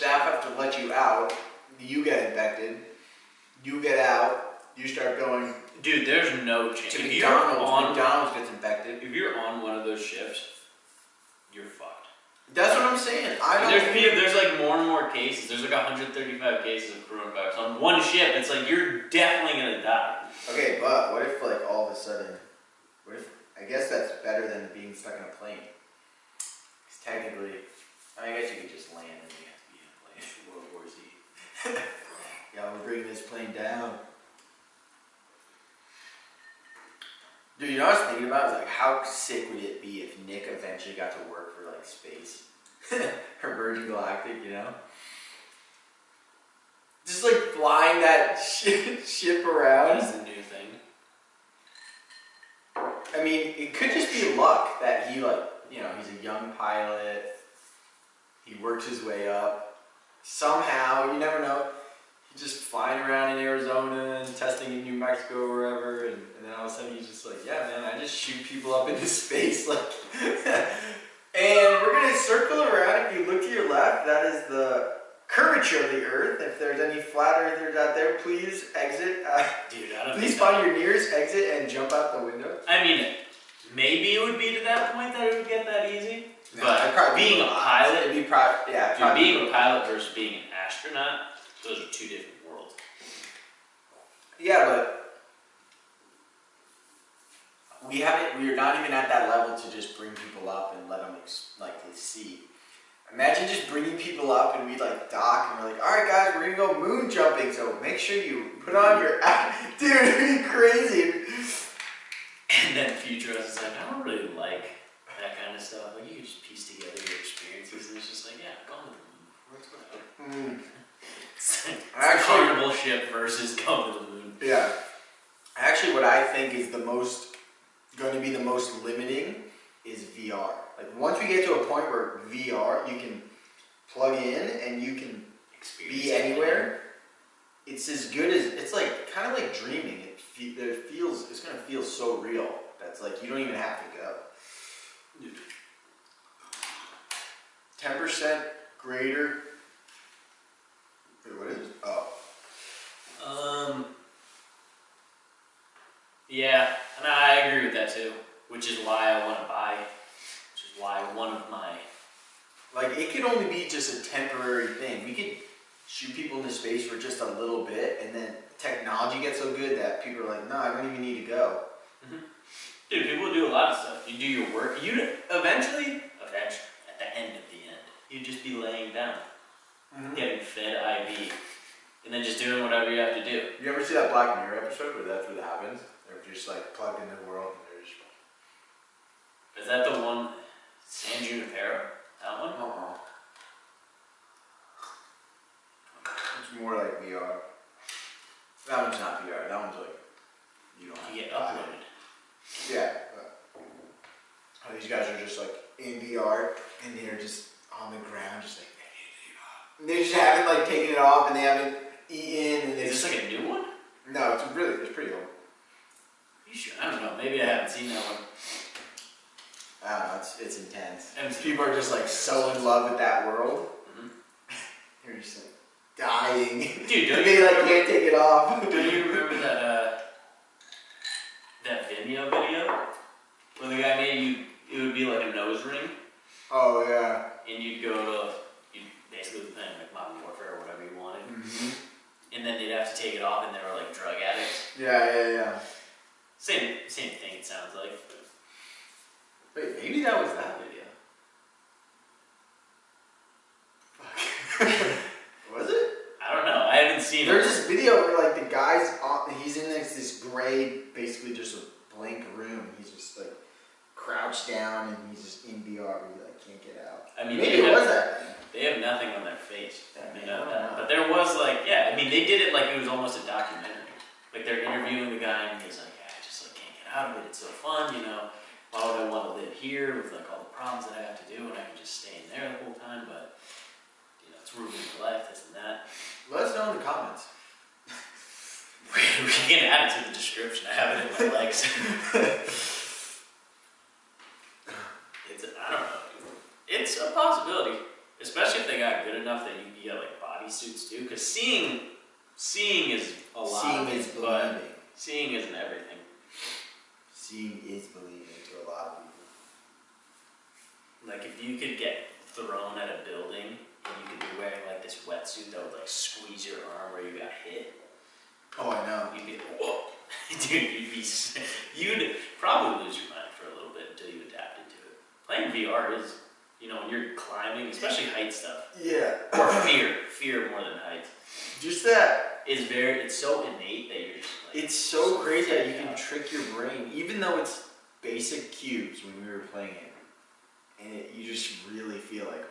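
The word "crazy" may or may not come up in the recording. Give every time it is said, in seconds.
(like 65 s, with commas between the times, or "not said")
110 s, 335 s.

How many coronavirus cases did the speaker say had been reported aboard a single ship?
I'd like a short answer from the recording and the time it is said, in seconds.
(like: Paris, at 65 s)
135, at 15 s.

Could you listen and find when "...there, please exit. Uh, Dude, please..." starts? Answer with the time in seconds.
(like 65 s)
77 s.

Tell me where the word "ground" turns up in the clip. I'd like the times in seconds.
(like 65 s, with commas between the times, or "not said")
207 s.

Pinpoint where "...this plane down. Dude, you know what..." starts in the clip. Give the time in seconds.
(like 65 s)
33 s.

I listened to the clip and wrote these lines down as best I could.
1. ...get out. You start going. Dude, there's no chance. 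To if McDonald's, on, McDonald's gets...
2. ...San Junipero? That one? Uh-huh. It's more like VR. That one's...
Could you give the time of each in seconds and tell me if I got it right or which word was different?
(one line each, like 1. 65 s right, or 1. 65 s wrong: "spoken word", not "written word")
1. 3 s right
2. 190 s right.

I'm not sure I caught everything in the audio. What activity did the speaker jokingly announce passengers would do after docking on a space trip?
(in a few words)
moon jumping.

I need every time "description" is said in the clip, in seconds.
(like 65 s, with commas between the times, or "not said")
290 s.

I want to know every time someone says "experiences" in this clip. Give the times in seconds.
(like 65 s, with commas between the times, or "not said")
117 s, 135 s.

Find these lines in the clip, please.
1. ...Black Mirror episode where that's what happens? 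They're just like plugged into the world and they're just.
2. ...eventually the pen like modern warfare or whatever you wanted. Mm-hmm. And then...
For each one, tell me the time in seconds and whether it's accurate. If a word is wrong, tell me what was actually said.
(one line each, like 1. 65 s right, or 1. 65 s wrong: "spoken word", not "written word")
1. 184 s right
2. 239 s wrong: "basically", not "eventually".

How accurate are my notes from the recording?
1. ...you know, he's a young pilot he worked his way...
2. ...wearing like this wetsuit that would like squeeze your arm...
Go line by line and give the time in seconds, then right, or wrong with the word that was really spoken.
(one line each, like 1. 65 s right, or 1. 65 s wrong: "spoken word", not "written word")
1. 55 s right
2. 314 s right.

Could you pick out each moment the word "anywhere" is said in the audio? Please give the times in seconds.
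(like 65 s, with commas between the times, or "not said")
136 s.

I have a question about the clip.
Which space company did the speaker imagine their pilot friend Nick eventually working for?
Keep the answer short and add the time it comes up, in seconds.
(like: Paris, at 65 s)
Virgin Galactic, at 43 s.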